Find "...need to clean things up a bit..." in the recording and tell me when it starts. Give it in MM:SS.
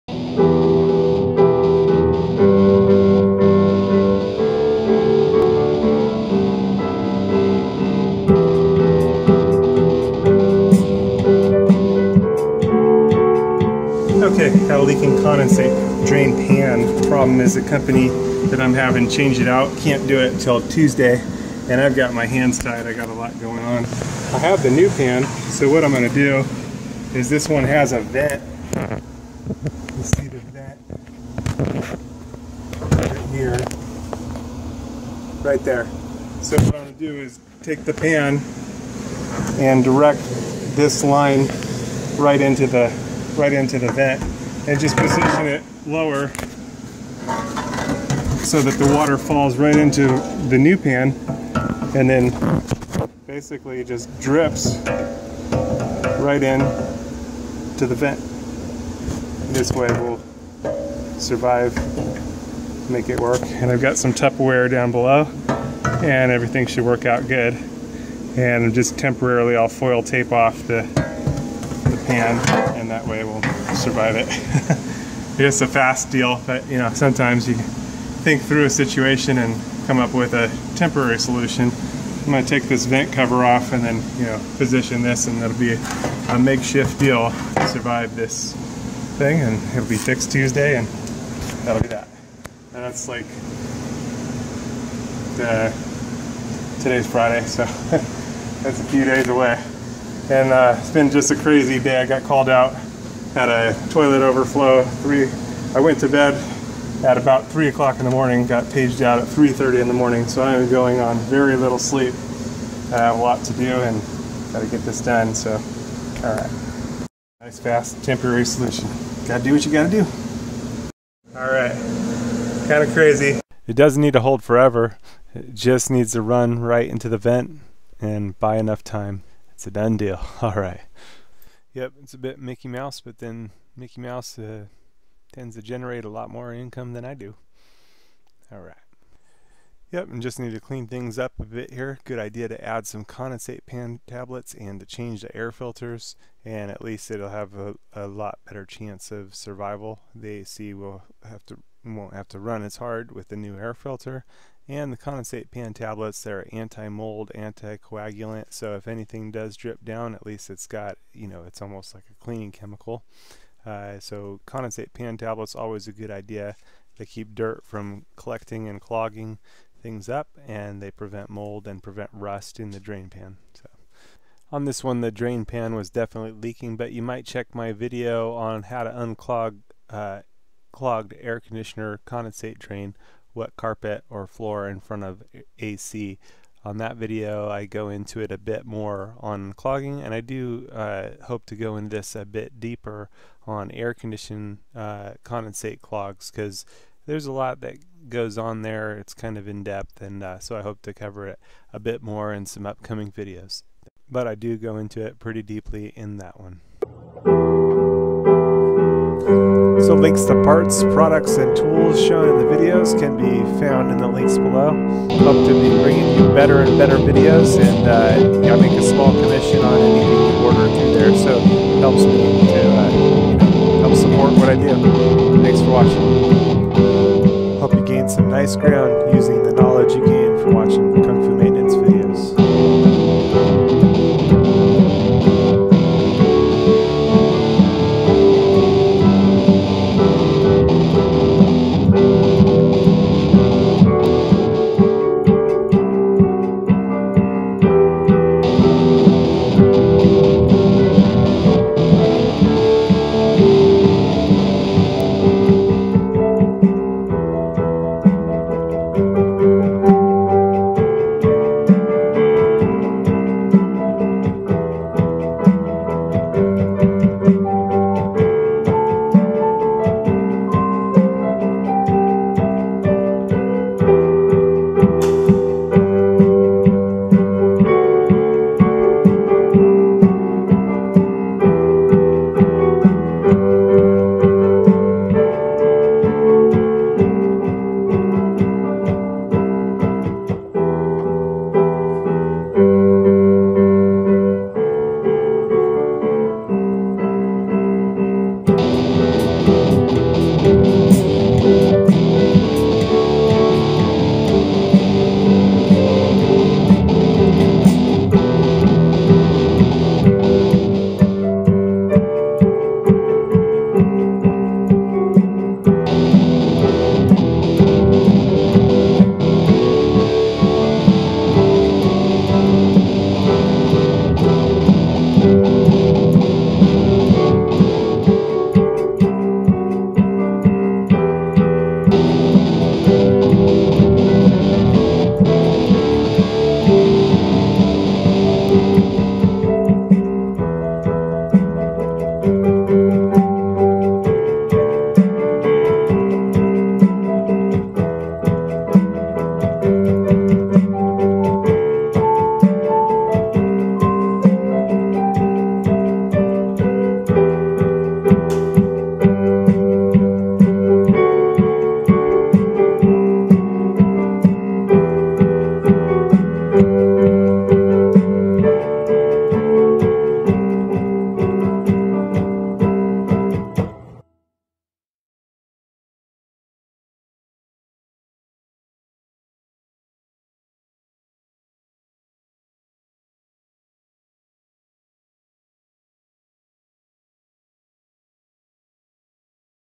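02:20.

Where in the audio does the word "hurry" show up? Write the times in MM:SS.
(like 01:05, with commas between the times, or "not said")
not said.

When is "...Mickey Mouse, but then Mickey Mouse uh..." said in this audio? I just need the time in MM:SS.
02:12.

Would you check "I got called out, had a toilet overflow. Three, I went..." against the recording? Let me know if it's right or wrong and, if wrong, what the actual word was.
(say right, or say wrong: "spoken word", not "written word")
right.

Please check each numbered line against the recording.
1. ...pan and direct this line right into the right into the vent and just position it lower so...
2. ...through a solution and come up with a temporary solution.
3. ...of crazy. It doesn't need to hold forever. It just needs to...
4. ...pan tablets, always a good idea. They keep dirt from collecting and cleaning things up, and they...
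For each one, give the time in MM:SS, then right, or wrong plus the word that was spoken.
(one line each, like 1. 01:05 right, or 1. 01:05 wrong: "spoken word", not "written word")
1. 00:37 right
2. 01:18 wrong: "situation", not "solution"
3. 02:02 right
4. 02:44 wrong: "clogging", not "cleaning".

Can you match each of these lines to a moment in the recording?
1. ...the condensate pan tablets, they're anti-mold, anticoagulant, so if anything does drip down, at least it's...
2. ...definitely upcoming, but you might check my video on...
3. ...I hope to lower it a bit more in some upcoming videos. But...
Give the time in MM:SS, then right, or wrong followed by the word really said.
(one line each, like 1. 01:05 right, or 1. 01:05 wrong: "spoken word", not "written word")
1. 02:34 right
2. 02:55 wrong: "leaking", not "upcoming"
3. 03:20 wrong: "cover", not "lower".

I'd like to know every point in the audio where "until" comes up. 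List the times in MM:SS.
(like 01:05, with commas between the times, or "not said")
00:20.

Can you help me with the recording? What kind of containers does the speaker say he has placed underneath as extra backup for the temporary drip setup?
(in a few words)
Tupperware.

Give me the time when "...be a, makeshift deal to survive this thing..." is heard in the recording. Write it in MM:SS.
01:25.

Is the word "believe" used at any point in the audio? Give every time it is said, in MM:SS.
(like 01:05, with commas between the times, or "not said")
not said.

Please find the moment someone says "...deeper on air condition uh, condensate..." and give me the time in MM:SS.
03:12.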